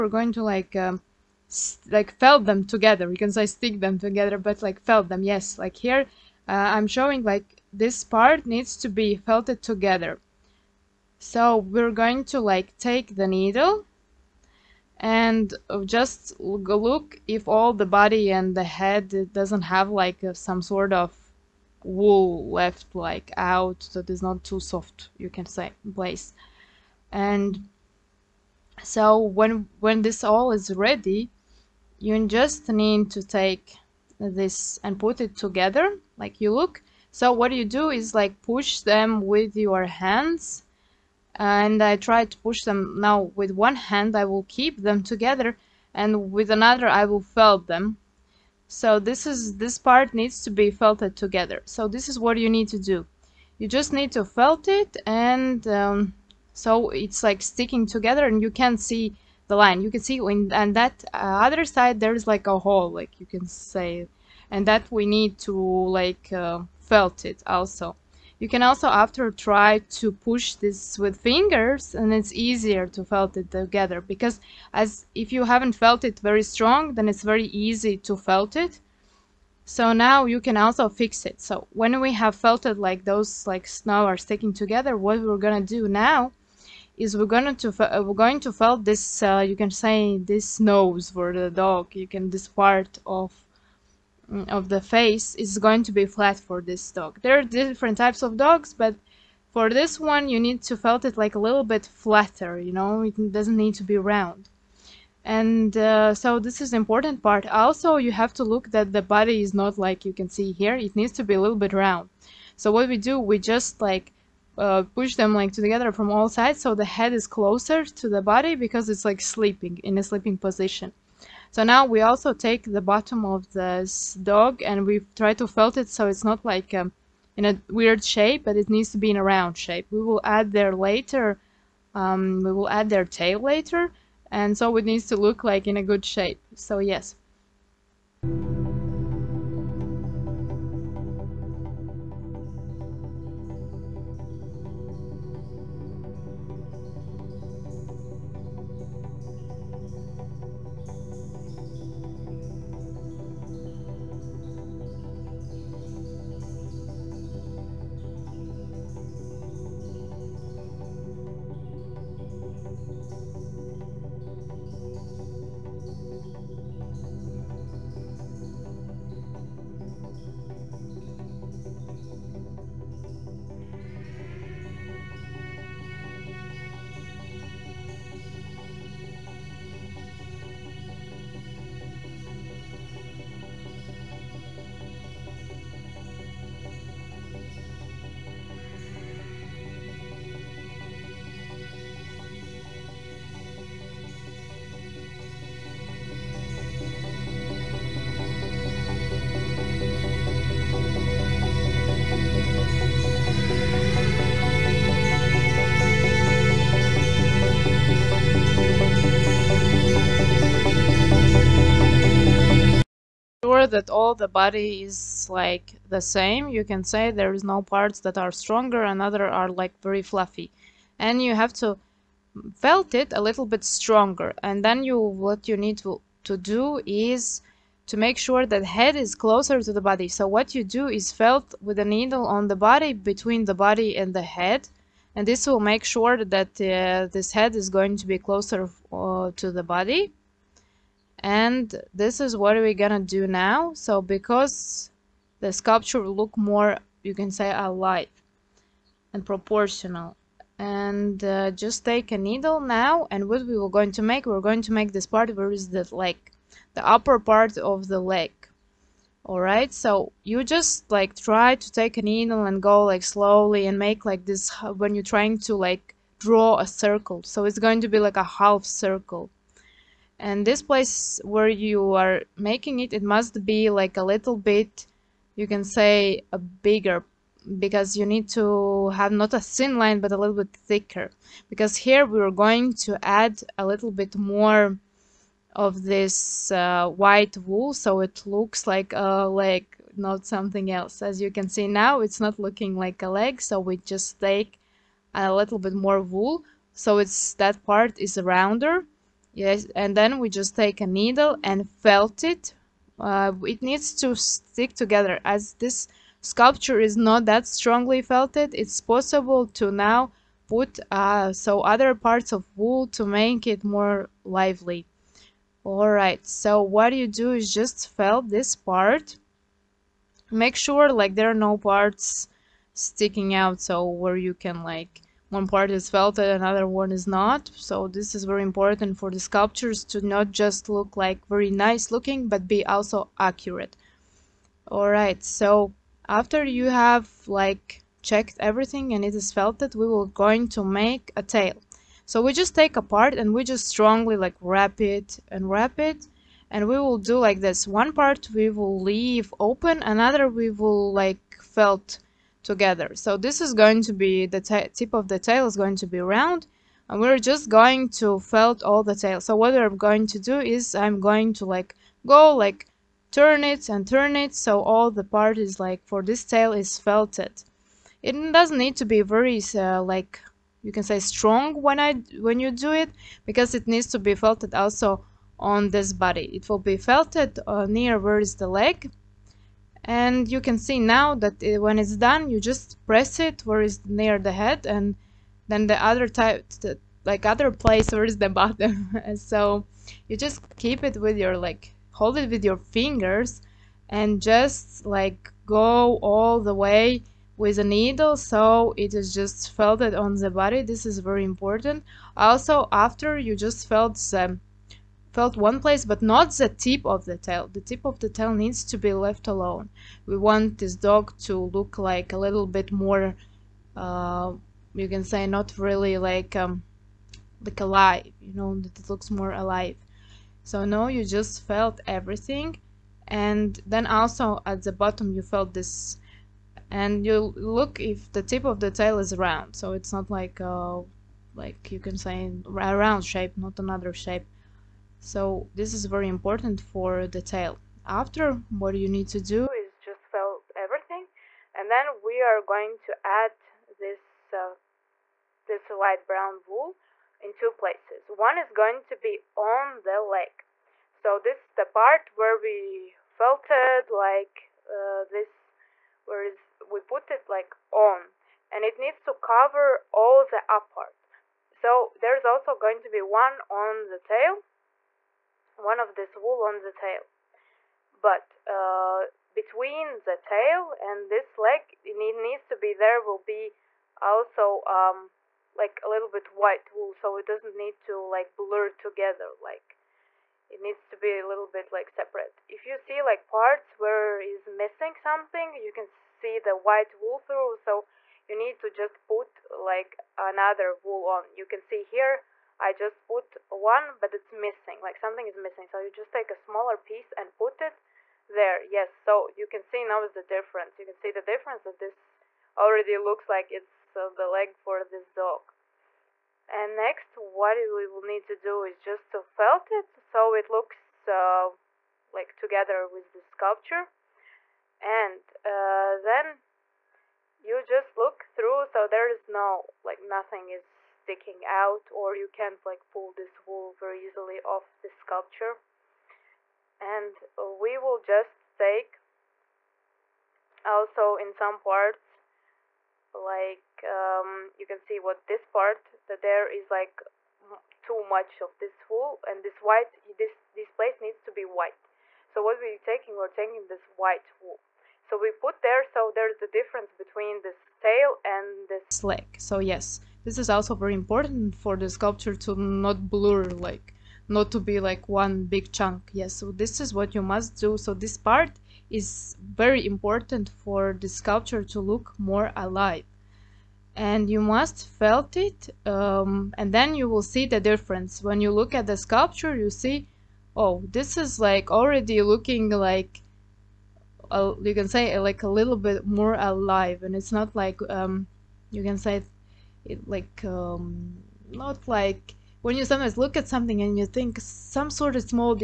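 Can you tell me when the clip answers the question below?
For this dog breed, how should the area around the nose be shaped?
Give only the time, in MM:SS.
01:41.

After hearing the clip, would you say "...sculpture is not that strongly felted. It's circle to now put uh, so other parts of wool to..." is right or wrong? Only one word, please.
wrong.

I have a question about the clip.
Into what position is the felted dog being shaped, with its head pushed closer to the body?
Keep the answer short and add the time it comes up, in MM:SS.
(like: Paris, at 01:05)
Sleeping position, at 02:00.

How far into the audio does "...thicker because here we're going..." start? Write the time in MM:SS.
04:40.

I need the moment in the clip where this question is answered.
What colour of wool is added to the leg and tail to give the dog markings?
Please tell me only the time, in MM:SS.
07:25.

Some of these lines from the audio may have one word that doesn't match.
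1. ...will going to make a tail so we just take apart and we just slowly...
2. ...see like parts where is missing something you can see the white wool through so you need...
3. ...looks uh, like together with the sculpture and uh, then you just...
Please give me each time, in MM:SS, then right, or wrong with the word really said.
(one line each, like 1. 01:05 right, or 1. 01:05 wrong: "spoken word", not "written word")
1. 05:39 wrong: "strongly", not "slowly"
2. 08:02 right
3. 08:30 right.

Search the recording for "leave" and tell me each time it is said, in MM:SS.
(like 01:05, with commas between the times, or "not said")
05:48.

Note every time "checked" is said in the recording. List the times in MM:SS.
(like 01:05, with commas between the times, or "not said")
05:38.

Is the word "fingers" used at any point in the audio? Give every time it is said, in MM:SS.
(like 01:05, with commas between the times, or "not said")
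01:11, 06:32.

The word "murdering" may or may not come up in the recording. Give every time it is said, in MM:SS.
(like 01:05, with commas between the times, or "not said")
not said.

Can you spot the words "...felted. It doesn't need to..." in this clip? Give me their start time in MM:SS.
06:06.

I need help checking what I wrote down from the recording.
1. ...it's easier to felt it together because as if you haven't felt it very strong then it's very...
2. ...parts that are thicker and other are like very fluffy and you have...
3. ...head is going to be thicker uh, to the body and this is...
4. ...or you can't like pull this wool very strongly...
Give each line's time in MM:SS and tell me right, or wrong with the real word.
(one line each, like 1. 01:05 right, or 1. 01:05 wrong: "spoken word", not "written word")
1. 01:12 right
2. 03:37 wrong: "stronger", not "thicker"
3. 03:57 wrong: "closer", not "thicker"
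4. 08:41 wrong: "easily", not "strongly".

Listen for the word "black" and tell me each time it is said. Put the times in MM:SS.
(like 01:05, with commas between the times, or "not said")
not said.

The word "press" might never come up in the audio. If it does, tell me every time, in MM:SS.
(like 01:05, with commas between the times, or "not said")
06:22.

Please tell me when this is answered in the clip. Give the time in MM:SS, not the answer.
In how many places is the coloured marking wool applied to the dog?
07:27.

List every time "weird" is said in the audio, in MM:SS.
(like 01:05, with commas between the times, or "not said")
02:07.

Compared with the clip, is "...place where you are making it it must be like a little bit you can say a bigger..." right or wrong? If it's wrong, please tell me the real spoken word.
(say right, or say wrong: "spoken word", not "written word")
right.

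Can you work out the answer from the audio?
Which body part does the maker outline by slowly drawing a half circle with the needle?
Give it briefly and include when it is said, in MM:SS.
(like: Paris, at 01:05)
Upper part of the leg, at 04:16.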